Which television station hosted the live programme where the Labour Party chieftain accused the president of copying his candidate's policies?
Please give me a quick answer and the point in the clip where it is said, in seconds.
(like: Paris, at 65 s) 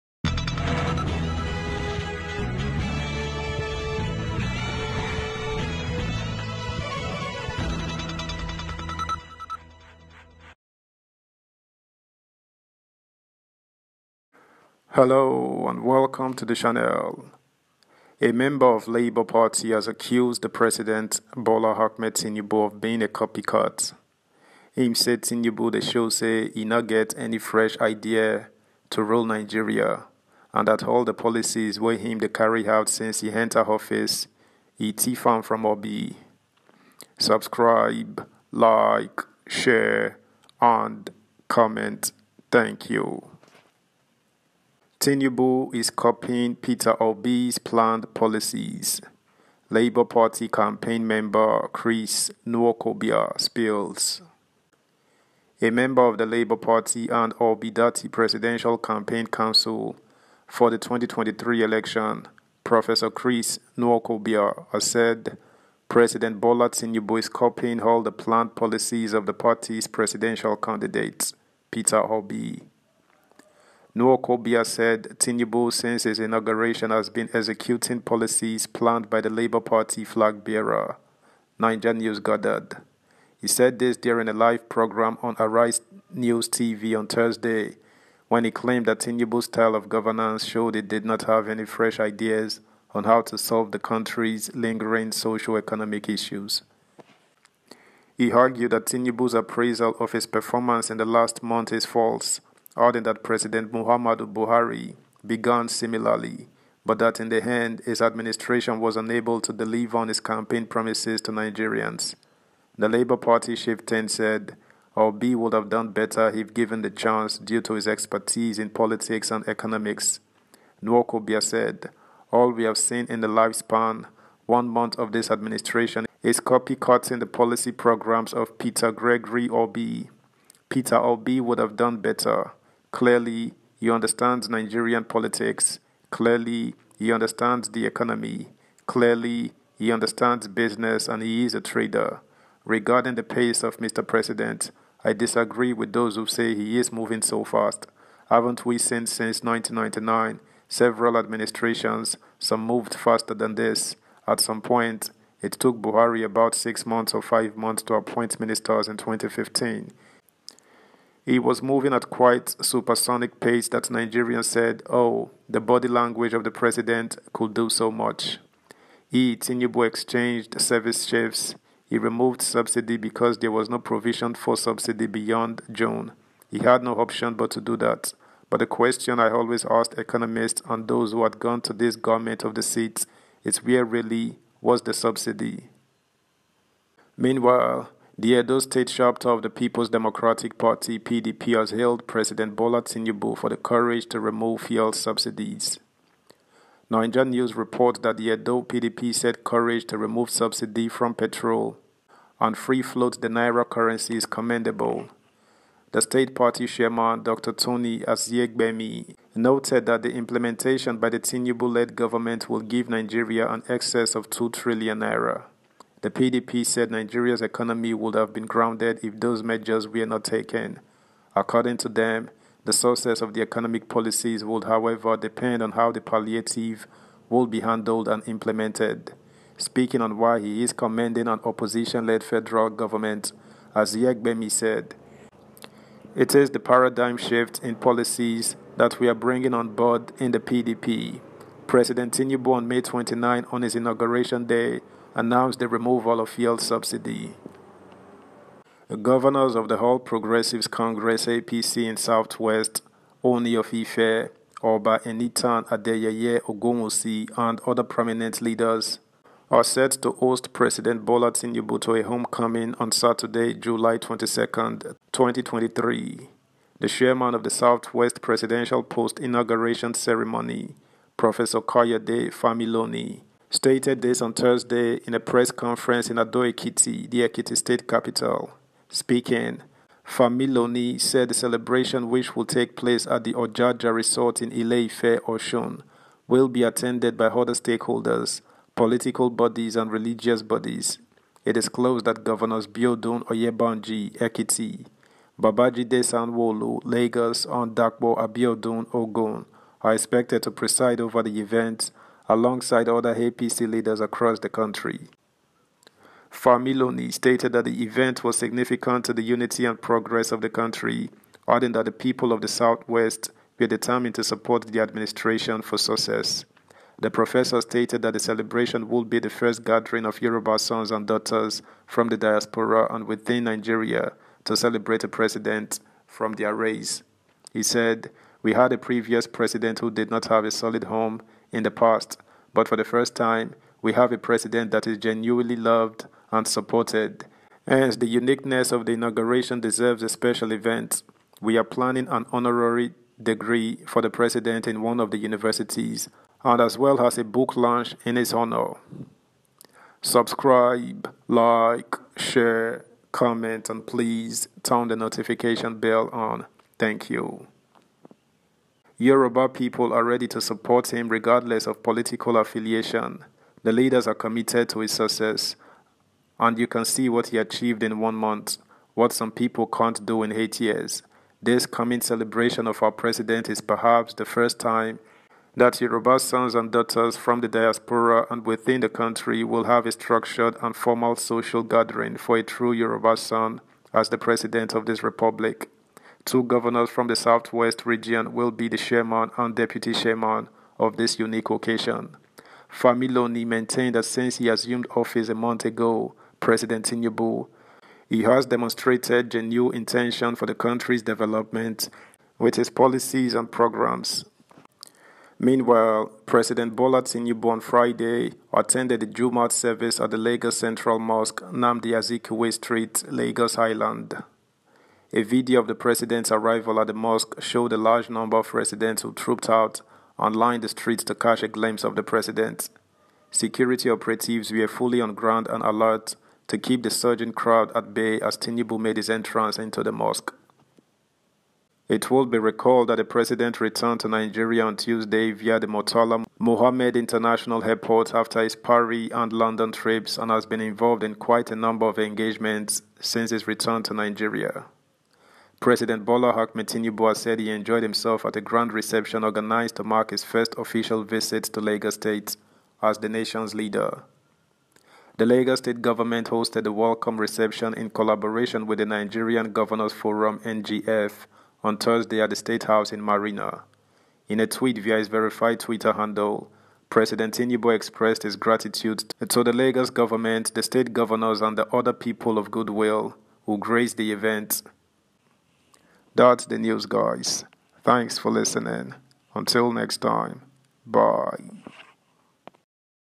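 Arise News TV, at 85 s.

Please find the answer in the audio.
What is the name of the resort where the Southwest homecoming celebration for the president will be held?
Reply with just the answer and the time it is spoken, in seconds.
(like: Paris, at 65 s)
Ojaja Resort, at 283 s.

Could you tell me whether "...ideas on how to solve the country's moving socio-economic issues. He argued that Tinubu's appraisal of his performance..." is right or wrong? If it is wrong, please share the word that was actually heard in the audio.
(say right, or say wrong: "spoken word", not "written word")
wrong: "lingering", not "moving".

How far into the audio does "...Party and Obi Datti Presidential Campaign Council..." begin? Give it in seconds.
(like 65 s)
56 s.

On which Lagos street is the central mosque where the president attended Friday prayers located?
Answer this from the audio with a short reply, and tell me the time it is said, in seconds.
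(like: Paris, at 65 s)
Nnamdi Azikiwe Street, at 411 s.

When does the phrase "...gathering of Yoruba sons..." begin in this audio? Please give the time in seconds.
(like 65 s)
319 s.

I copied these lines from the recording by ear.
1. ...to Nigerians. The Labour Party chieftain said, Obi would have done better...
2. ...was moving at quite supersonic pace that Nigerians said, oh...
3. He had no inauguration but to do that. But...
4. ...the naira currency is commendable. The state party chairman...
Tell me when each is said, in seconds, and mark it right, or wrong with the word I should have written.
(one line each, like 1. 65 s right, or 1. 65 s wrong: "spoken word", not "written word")
1. 111 s right
2. 161 s right
3. 176 s wrong: "option", not "inauguration"
4. 203 s right.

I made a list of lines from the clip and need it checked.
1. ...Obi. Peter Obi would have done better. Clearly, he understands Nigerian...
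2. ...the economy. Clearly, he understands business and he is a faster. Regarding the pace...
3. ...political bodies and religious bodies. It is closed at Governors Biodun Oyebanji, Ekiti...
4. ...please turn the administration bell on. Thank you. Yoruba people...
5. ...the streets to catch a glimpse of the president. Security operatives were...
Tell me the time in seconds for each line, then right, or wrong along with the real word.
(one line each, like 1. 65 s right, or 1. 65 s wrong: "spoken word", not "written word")
1. 129 s right
2. 137 s wrong: "trader", not "faster"
3. 288 s right
4. 353 s wrong: "notification", not "administration"
5. 420 s right.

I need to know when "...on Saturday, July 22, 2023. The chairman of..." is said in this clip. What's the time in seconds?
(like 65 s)
262 s.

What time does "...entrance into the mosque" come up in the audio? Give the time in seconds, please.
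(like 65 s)
429 s.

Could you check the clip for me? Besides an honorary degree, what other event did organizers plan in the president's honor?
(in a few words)
A book launch.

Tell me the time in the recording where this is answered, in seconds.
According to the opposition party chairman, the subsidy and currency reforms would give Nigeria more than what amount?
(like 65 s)
214 s.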